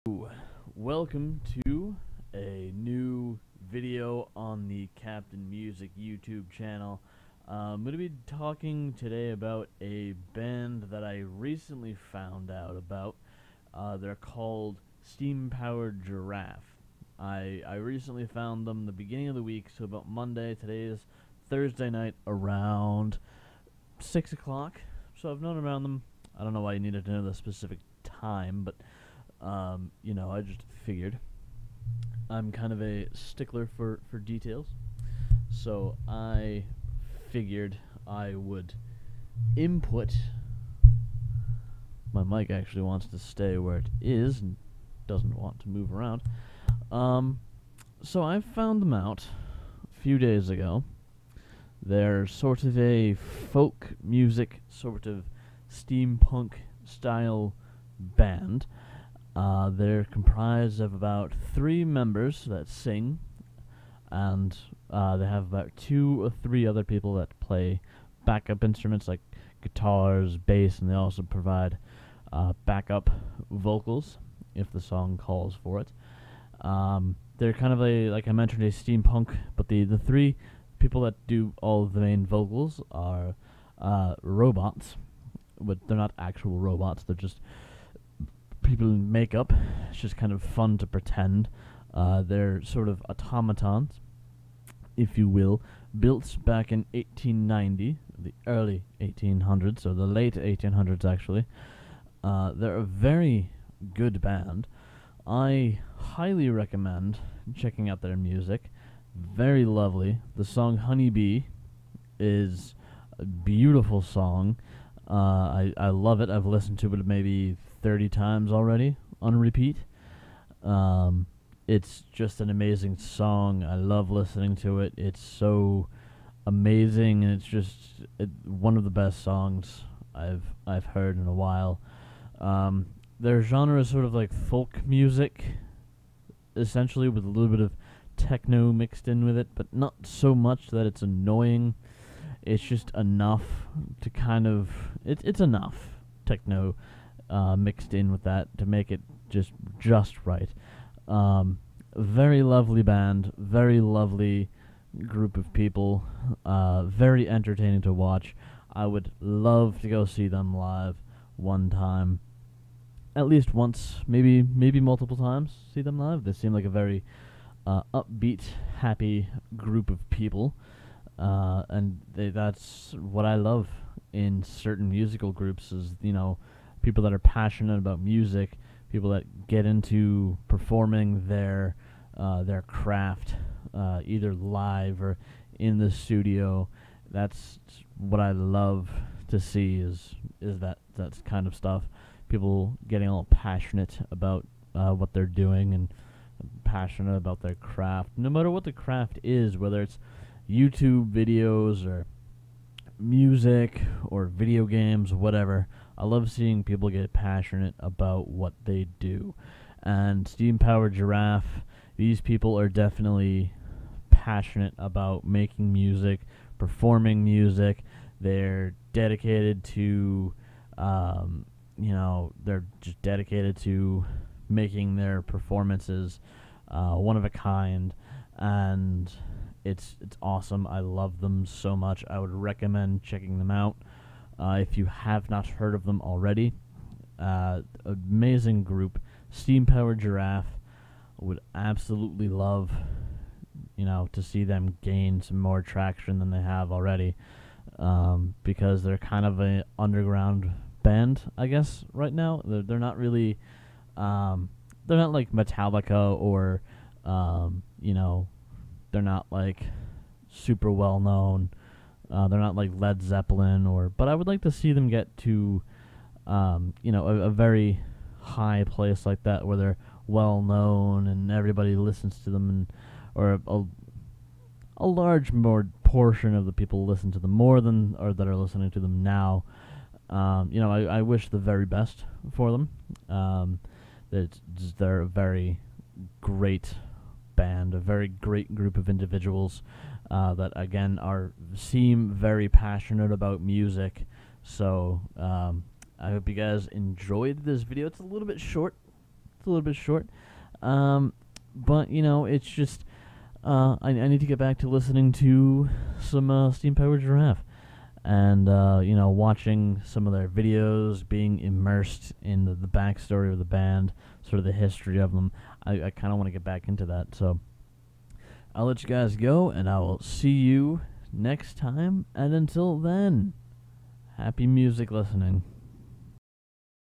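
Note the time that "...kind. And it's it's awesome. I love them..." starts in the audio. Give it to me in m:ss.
3:47.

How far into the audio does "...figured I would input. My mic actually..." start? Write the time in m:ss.
0:37.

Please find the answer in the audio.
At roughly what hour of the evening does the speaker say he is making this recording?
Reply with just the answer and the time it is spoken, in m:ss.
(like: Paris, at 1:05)
6 o'clock, at 0:23.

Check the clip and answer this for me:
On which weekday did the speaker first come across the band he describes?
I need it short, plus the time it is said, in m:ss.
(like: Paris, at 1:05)
Monday, at 0:20.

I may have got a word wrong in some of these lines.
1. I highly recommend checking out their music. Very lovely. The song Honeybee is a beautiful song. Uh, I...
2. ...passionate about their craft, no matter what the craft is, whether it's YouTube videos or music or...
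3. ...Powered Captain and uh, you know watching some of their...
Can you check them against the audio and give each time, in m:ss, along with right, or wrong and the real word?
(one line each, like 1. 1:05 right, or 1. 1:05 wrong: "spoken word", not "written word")
1. 1:45 right
2. 3:16 right
3. 5:06 wrong: "Giraffe", not "Captain".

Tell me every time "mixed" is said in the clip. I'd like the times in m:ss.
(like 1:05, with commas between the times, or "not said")
2:18, 2:27.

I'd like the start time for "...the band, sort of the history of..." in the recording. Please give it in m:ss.
5:13.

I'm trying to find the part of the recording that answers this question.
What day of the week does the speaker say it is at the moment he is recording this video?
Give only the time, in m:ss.
0:21.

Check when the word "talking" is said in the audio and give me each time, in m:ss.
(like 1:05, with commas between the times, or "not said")
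0:08.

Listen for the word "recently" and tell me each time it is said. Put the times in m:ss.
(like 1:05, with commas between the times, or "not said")
0:11, 0:17.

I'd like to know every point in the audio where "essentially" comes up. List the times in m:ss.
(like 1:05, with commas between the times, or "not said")
2:16.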